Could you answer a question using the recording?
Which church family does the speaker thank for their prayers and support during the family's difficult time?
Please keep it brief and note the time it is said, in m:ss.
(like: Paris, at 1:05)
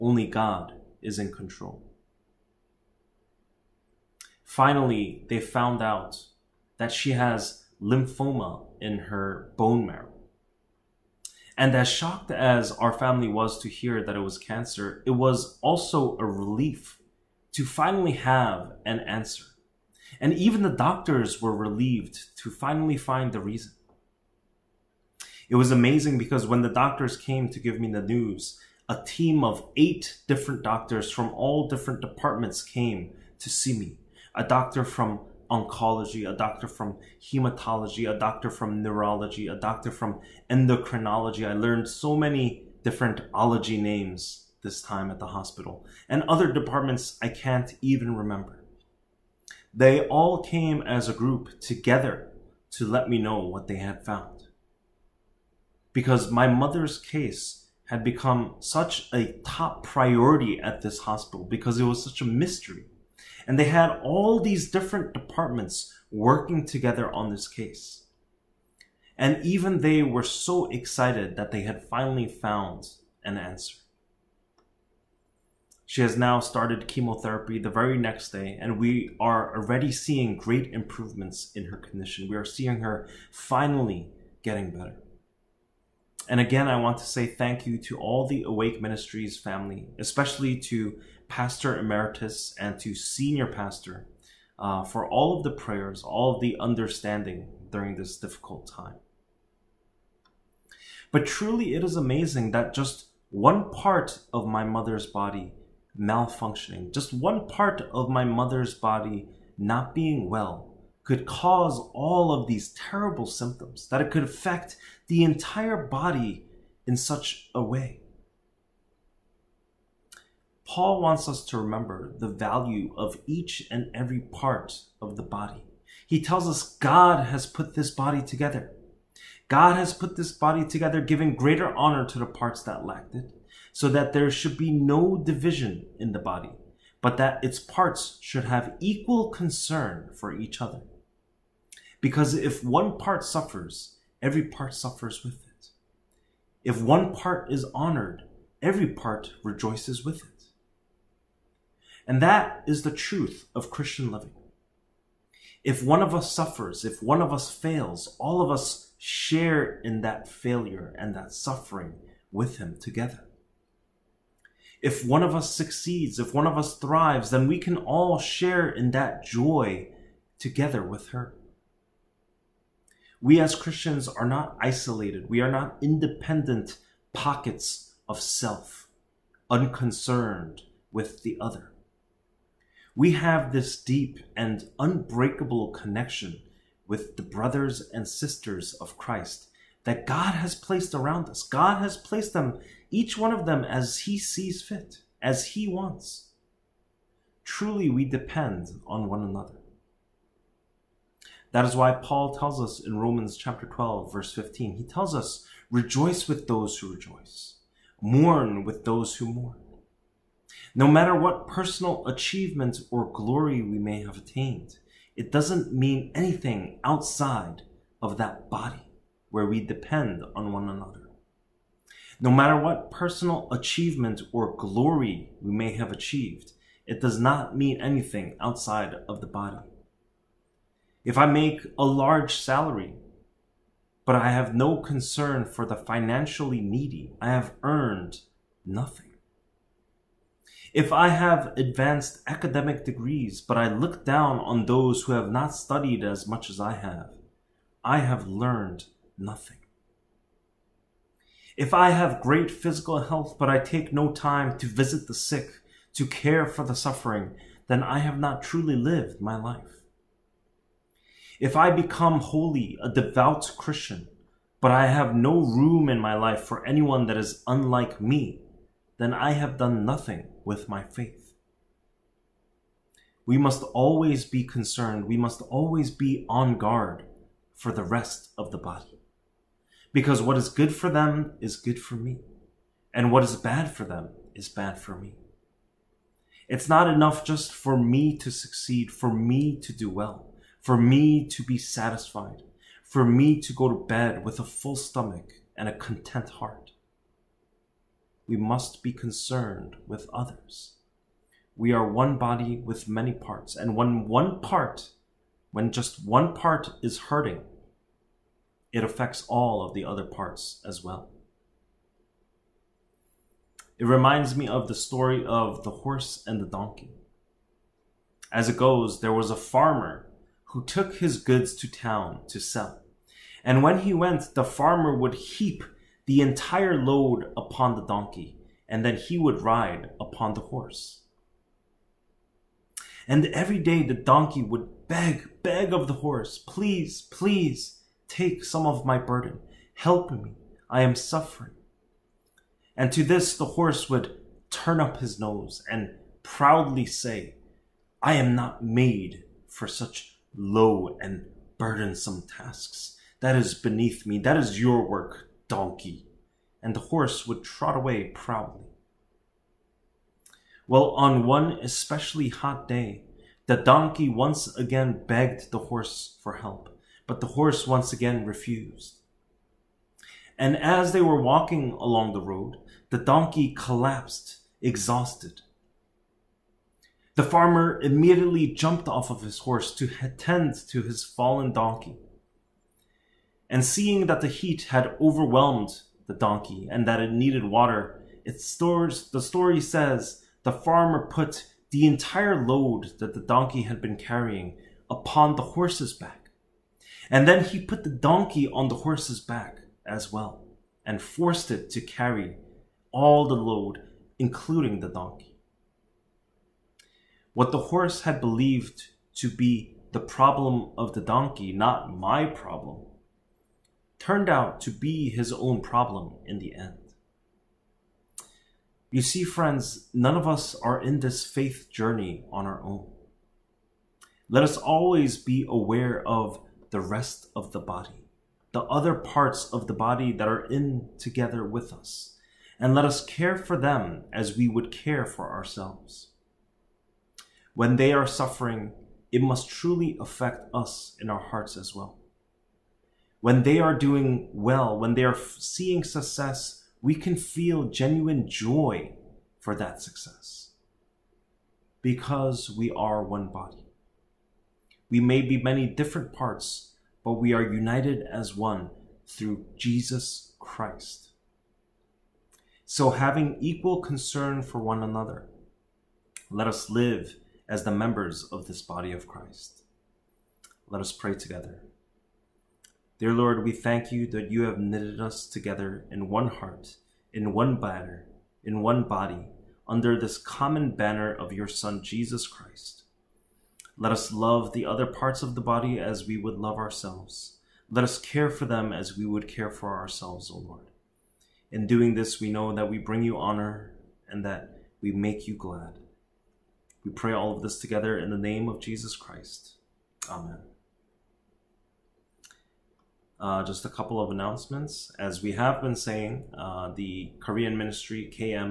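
Awake Ministries, at 1:28.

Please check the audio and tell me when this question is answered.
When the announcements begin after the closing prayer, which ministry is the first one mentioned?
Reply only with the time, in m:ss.
8:27.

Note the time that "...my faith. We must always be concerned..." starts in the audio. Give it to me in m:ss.
4:30.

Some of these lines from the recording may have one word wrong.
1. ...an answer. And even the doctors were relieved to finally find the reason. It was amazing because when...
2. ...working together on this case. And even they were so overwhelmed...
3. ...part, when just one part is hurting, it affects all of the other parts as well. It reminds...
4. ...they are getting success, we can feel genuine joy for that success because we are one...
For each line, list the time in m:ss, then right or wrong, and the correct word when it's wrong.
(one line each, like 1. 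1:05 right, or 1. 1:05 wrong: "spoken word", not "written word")
1. 0:18 right
2. 1:06 wrong: "excited", not "overwhelmed"
3. 5:04 right
4. 7:24 wrong: "seeing", not "getting".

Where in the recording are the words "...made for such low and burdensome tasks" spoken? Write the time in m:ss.
5:48.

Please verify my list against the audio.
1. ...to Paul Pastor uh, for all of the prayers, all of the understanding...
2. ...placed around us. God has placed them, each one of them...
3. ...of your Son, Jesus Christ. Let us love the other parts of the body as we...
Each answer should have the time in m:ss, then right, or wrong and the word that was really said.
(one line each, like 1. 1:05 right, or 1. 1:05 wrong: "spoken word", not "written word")
1. 1:32 wrong: "Senior", not "Paul"
2. 3:10 right
3. 8:01 right.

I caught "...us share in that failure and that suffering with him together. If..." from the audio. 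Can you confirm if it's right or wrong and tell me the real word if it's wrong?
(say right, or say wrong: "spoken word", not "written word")
right.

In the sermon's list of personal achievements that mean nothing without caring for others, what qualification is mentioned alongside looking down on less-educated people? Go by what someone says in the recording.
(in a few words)
advanced academic degrees.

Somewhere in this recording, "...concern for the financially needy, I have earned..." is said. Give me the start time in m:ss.
3:54.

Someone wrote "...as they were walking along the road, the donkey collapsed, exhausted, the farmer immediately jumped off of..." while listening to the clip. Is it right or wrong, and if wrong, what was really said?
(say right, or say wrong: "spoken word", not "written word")
right.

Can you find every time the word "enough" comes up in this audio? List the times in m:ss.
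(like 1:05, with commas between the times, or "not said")
4:46.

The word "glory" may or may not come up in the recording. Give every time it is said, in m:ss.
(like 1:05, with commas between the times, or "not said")
3:33, 3:44.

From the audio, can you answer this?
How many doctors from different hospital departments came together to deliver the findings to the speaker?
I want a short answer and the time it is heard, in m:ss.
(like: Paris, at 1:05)
8, at 0:29.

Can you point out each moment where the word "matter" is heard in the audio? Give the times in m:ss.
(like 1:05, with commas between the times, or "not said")
3:30, 3:42.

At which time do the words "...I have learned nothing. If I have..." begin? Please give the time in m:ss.
4:07.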